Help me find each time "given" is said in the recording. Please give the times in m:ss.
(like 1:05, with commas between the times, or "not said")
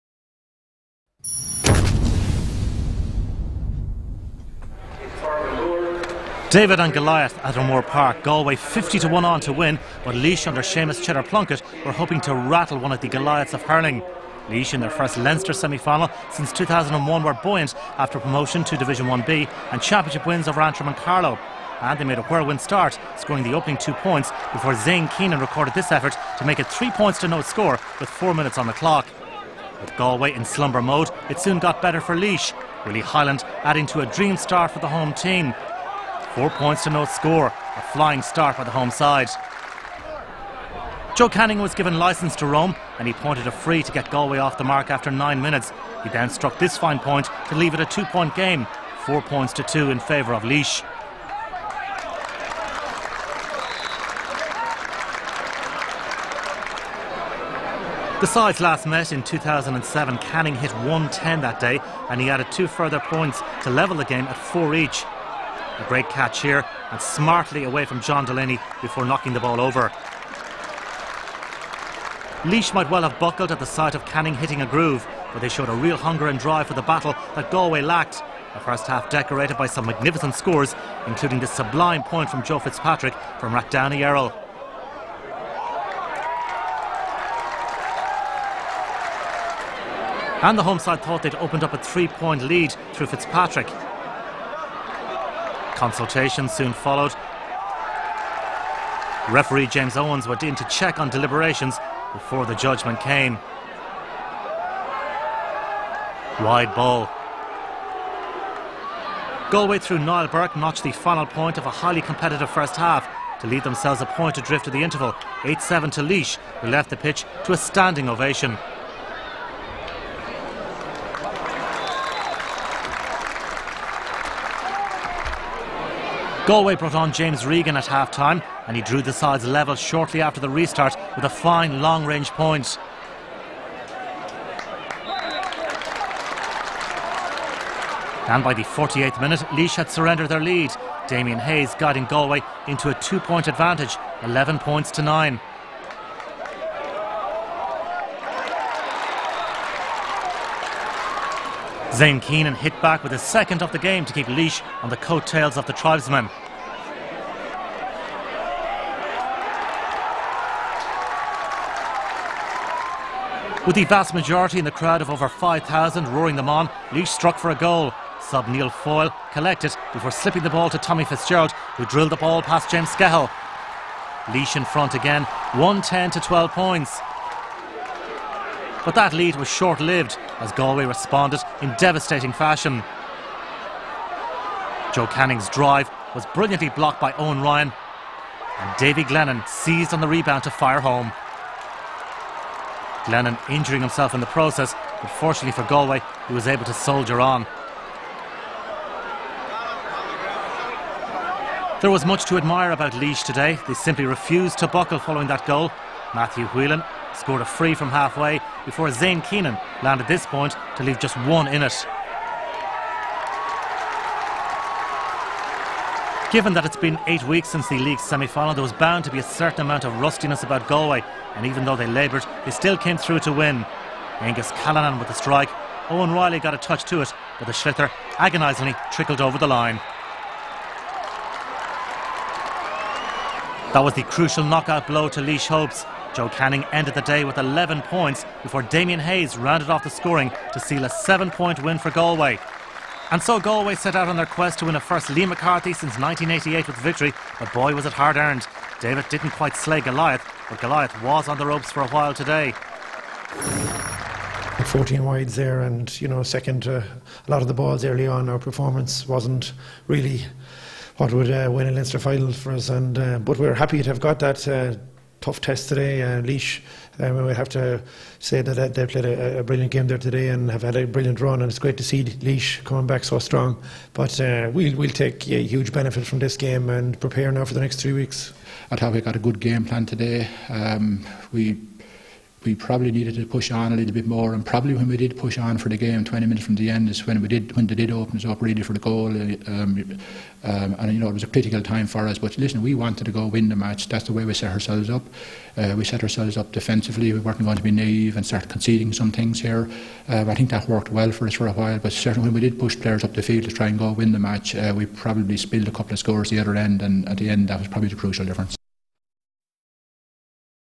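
0:41, 3:36.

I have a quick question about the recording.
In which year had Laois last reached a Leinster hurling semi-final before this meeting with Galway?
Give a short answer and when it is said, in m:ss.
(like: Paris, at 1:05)
2001, at 0:16.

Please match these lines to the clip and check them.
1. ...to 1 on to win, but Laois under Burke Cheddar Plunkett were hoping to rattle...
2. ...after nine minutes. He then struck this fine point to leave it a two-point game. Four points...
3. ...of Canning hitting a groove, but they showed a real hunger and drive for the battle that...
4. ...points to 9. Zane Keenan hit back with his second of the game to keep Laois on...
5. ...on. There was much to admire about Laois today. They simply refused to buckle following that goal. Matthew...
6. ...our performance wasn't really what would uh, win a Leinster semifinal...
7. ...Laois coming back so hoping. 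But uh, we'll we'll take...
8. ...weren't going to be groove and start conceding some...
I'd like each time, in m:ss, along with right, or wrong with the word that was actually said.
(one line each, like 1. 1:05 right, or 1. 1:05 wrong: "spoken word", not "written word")
1. 0:08 wrong: "Seamus", not "Burke"
2. 0:44 right
3. 1:13 right
4. 2:24 right
5. 3:17 right
6. 4:18 wrong: "final", not "semifinal"
7. 4:32 wrong: "strong", not "hoping"
8. 4:57 wrong: "naive", not "groove".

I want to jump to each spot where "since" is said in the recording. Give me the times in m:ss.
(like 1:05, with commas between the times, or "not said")
0:16, 3:37, 4:05.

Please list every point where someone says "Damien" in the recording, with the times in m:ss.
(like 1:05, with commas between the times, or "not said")
2:21, 3:58.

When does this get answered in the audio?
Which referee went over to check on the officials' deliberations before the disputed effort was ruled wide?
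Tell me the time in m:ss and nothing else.
1:39.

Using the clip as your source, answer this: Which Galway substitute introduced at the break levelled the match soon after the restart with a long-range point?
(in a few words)
James Regan.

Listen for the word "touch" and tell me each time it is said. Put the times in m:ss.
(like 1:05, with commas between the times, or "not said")
3:46.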